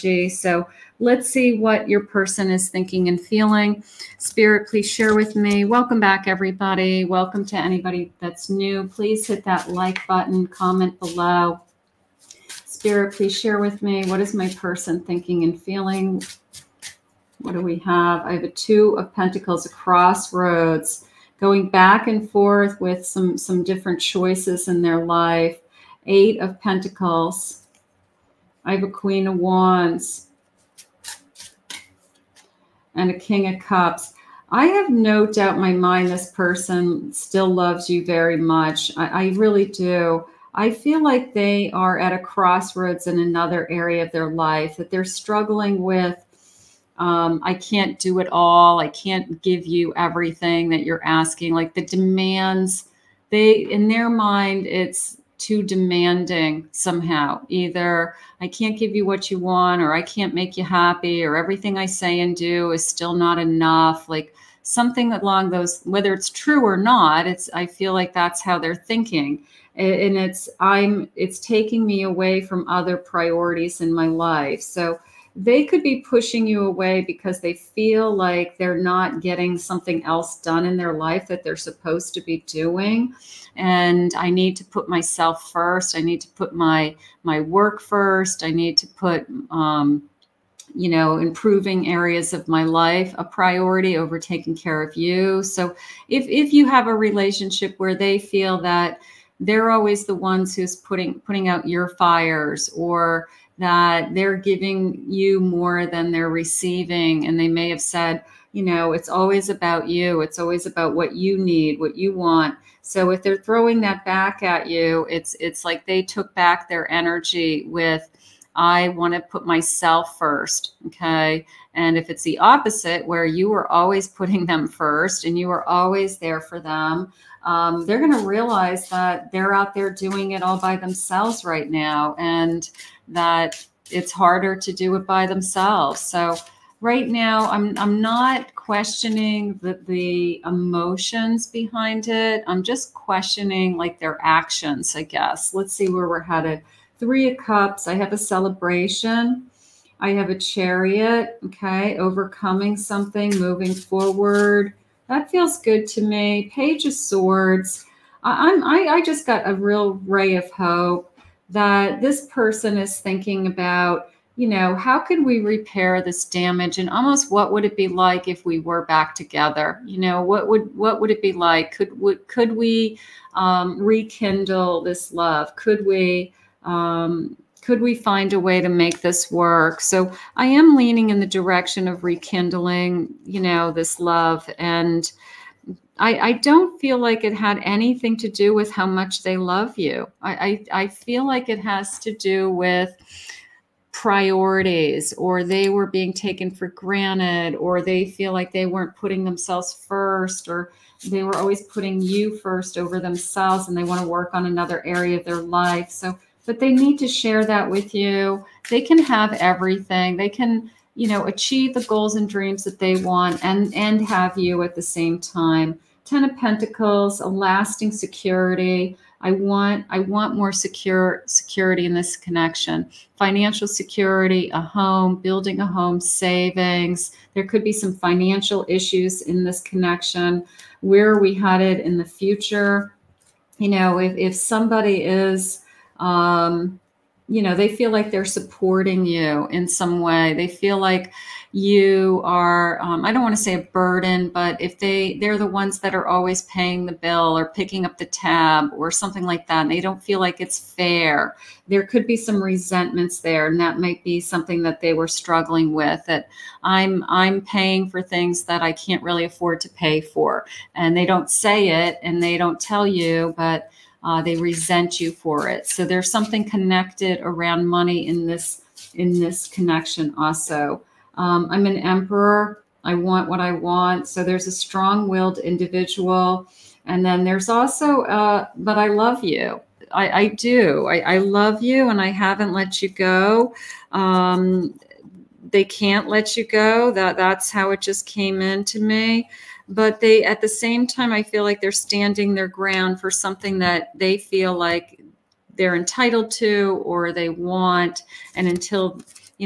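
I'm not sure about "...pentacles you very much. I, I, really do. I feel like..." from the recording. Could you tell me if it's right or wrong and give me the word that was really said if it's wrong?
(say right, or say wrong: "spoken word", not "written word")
wrong: "loves", not "pentacles".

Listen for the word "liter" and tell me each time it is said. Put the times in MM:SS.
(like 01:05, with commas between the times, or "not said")
not said.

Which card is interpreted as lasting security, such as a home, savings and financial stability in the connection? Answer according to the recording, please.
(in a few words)
10 of Pentacles.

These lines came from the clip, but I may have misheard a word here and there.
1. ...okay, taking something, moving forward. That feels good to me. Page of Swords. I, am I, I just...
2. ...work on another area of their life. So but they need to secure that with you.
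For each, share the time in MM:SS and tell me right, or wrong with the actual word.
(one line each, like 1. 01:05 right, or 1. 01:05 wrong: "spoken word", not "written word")
1. 02:31 wrong: "overcoming", not "taking"
2. 03:24 wrong: "share", not "secure".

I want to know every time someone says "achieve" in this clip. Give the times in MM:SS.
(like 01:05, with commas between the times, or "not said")
03:31.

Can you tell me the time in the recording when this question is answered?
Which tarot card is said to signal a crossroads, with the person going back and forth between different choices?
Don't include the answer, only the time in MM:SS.
00:18.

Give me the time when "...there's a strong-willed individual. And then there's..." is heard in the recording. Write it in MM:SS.
04:34.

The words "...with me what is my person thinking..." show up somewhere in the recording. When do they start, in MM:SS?
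00:13.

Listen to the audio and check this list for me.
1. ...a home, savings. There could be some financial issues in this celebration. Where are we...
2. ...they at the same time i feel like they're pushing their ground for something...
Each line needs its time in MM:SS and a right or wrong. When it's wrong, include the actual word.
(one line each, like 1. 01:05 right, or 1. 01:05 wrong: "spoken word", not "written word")
1. 03:45 wrong: "connection", not "celebration"
2. 04:50 wrong: "standing", not "pushing".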